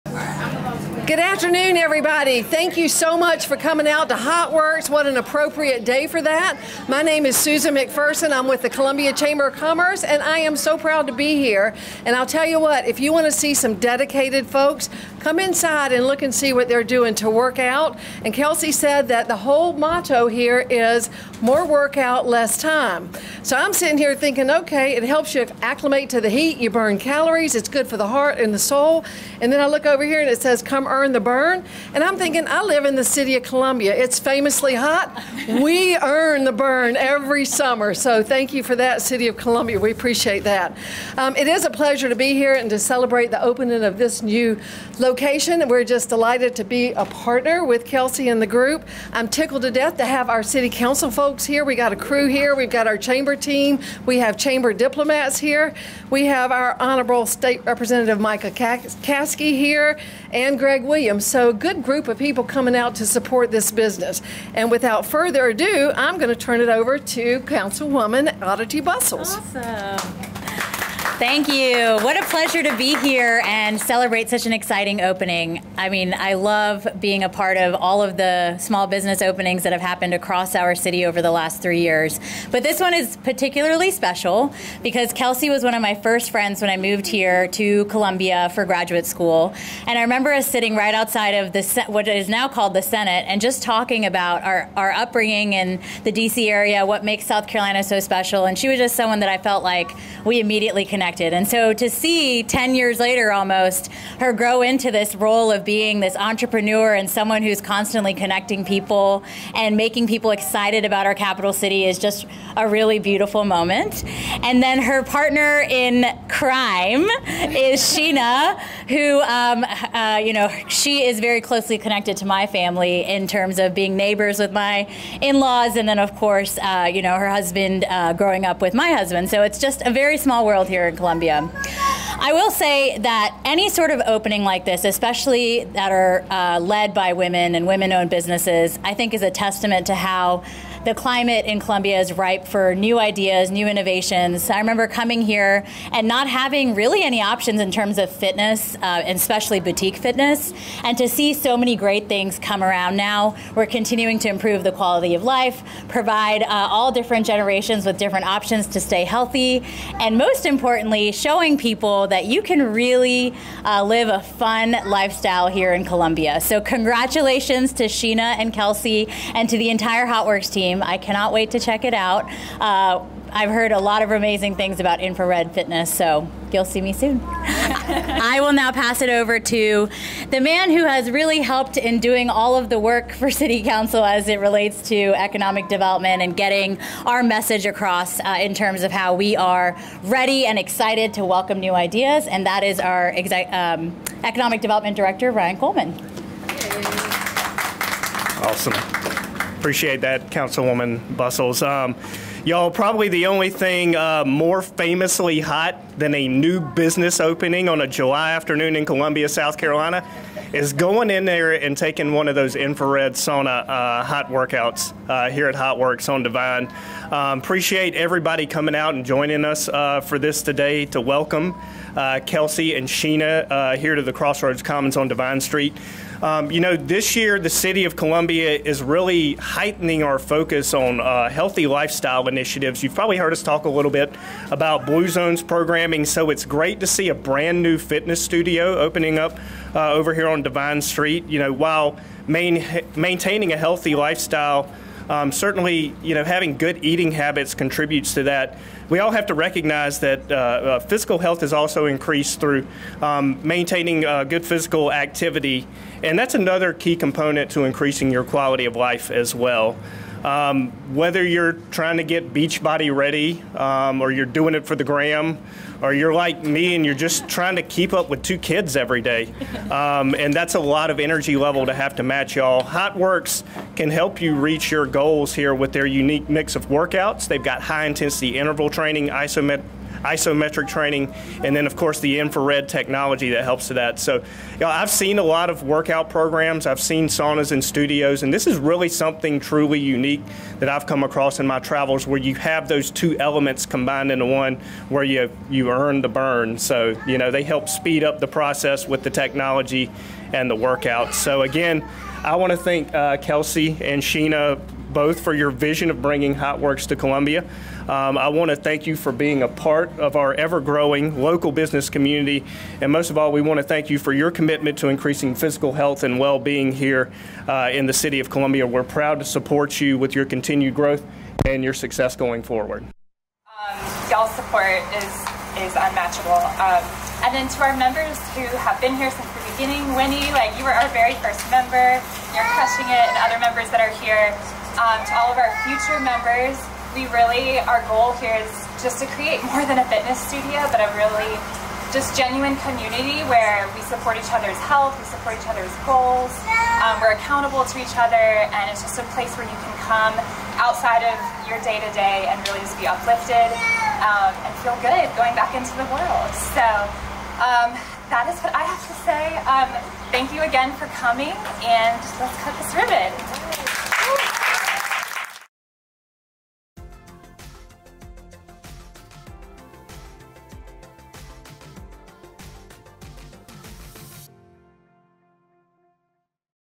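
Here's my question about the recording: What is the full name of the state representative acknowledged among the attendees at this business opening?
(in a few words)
Micah Caskey.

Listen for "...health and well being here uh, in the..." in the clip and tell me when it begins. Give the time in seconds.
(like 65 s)
315 s.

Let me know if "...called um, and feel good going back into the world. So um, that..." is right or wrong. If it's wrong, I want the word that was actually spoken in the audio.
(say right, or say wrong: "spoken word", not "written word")
wrong: "uplifted", not "called".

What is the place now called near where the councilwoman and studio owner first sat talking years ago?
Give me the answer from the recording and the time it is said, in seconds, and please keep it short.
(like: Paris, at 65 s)
the Senate, at 92 s.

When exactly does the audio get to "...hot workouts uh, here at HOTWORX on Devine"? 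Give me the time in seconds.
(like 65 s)
214 s.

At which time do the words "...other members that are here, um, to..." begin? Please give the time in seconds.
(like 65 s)
333 s.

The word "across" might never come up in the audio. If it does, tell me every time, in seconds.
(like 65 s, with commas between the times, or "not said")
80 s, 187 s, 291 s.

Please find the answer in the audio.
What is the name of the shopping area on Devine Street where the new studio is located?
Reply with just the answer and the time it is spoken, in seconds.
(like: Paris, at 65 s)
Crossroads Commons, at 224 s.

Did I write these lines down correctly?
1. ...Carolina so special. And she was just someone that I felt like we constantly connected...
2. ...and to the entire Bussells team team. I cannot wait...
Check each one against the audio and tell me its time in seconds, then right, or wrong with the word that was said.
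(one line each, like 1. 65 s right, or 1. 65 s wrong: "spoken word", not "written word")
1. 97 s wrong: "immediately", not "constantly"
2. 169 s wrong: "HOTWORX", not "Bussells".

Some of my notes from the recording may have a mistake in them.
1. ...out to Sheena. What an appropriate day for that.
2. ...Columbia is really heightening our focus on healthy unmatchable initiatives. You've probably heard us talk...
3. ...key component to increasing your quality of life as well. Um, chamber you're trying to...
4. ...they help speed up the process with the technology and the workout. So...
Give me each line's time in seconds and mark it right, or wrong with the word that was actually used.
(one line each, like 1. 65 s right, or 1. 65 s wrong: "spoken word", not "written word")
1. 3 s wrong: "HOTWORX", not "Sheena"
2. 227 s wrong: "lifestyle", not "unmatchable"
3. 256 s wrong: "whether", not "chamber"
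4. 297 s right.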